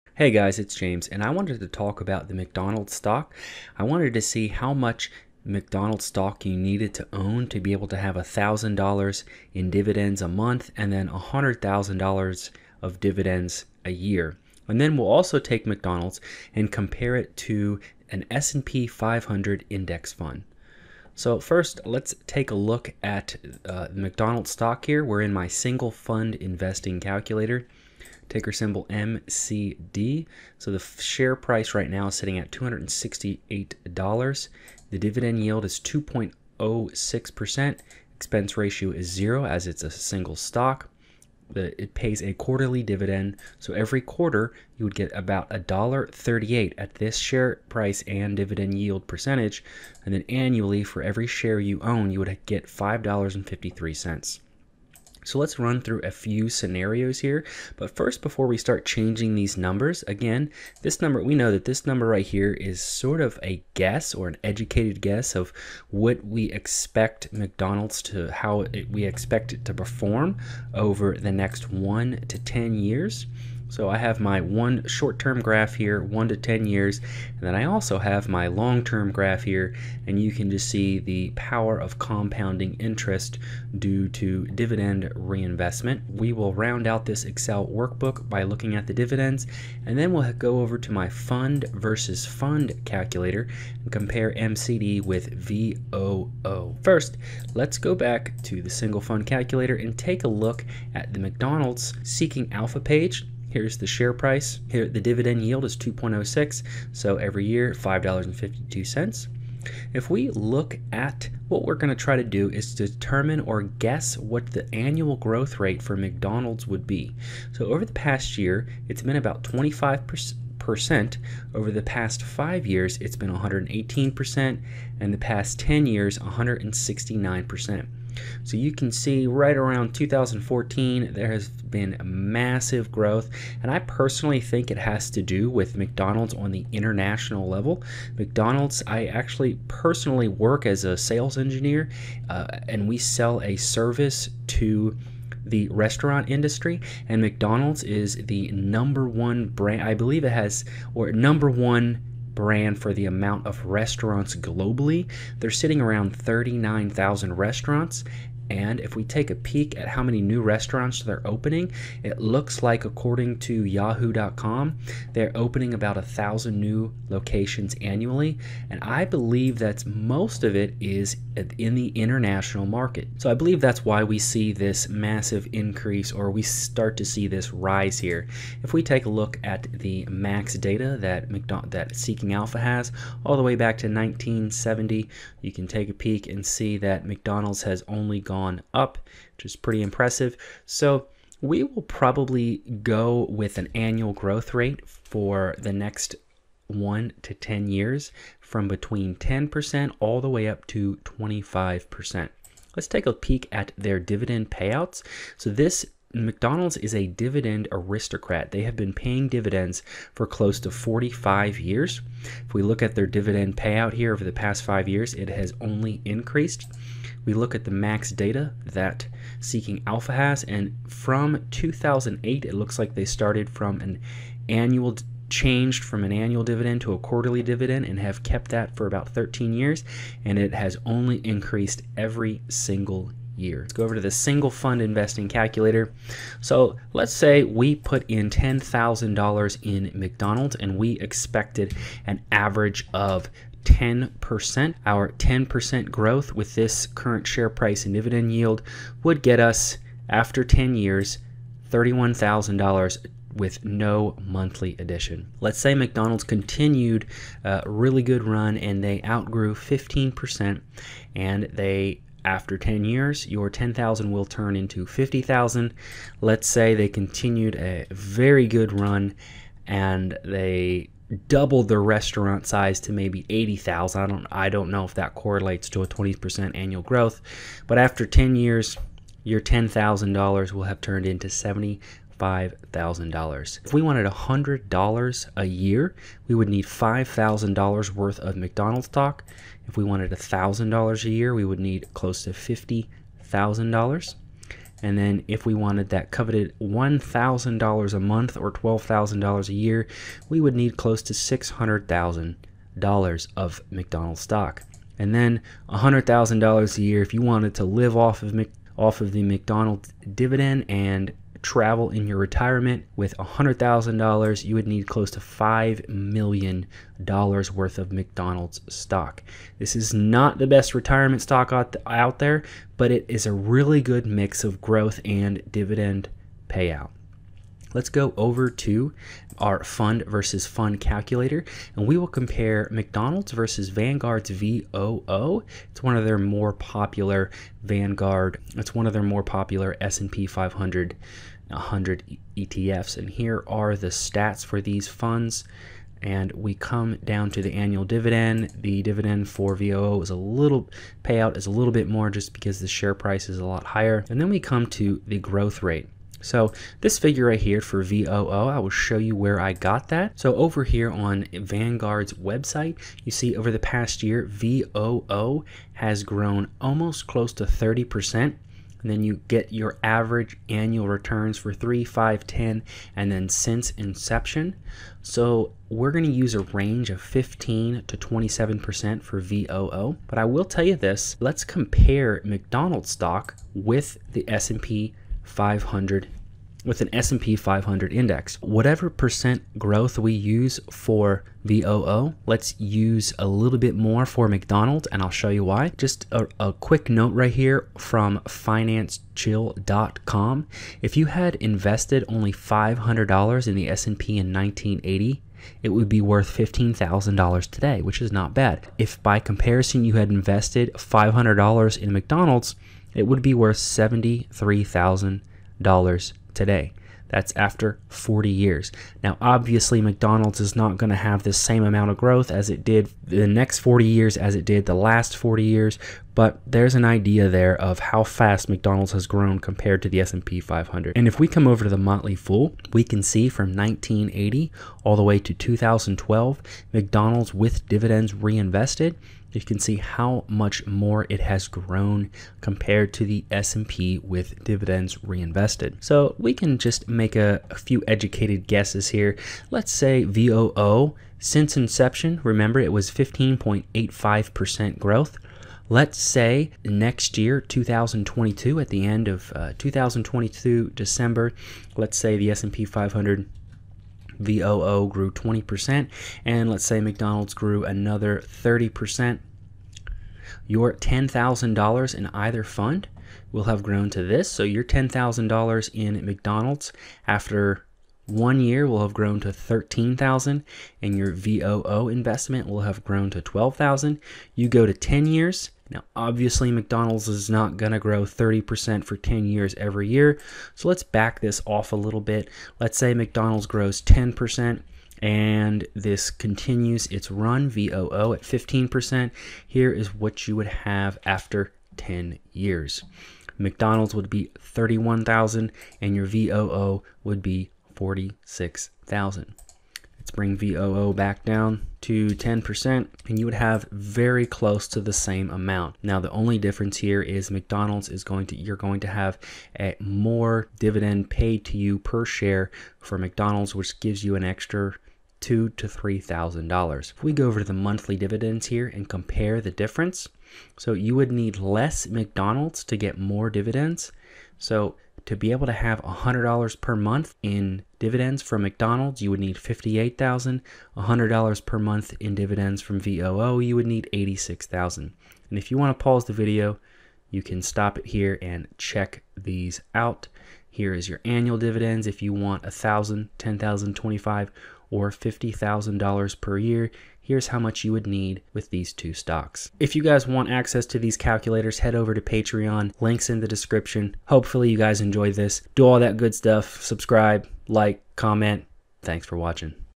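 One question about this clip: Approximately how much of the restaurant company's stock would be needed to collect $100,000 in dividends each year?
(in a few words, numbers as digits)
$5 million.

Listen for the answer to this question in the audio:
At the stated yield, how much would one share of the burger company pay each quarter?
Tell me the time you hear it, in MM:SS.
00:45.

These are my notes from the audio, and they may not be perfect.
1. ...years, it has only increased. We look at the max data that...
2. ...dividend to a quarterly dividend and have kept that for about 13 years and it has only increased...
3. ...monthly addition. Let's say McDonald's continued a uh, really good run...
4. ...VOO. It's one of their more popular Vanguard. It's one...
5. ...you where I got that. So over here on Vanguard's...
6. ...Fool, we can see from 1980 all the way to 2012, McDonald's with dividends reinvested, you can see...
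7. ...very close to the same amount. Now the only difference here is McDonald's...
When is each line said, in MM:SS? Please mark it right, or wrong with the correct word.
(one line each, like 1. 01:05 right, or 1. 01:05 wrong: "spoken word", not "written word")
1. 03:34 right
2. 03:46 right
3. 04:14 right
4. 05:34 right
5. 05:58 right
6. 07:12 right
7. 08:33 right.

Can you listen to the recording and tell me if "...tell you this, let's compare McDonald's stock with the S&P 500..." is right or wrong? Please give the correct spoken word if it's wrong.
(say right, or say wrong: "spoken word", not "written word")
right.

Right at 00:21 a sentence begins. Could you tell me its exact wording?
So first, let's take a look at uh, McDonald's stock here.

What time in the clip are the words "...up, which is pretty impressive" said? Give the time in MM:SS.
03:08.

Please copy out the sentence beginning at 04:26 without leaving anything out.
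Let's say they continued a very good run and they doubled their restaurant size to maybe 80,000.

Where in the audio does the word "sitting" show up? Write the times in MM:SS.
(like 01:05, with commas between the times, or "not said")
00:32, 02:35.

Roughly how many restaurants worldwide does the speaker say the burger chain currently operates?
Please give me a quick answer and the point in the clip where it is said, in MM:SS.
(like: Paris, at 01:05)
39,000, at 02:36.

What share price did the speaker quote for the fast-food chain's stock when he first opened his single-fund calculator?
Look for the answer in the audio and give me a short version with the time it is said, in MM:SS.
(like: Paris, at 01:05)
$268, at 00:32.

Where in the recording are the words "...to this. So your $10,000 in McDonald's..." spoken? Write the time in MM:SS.
07:53.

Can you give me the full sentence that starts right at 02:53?
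So I believe that's why we see this massive increase or we start to see this rise here.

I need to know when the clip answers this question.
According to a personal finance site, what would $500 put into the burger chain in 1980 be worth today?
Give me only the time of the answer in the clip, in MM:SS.
06:53.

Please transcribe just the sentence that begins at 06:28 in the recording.
Whatever percent growth we use for VOO, let's use a little bit more for McDonald's and I'll show you why.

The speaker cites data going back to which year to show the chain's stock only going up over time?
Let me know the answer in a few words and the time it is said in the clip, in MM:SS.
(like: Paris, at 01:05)
1970, at 03:03.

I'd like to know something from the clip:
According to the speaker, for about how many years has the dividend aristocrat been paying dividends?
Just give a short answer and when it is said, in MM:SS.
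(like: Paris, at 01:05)
45 years, at 03:30.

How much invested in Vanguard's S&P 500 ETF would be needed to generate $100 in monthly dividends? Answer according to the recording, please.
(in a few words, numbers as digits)
$86,000.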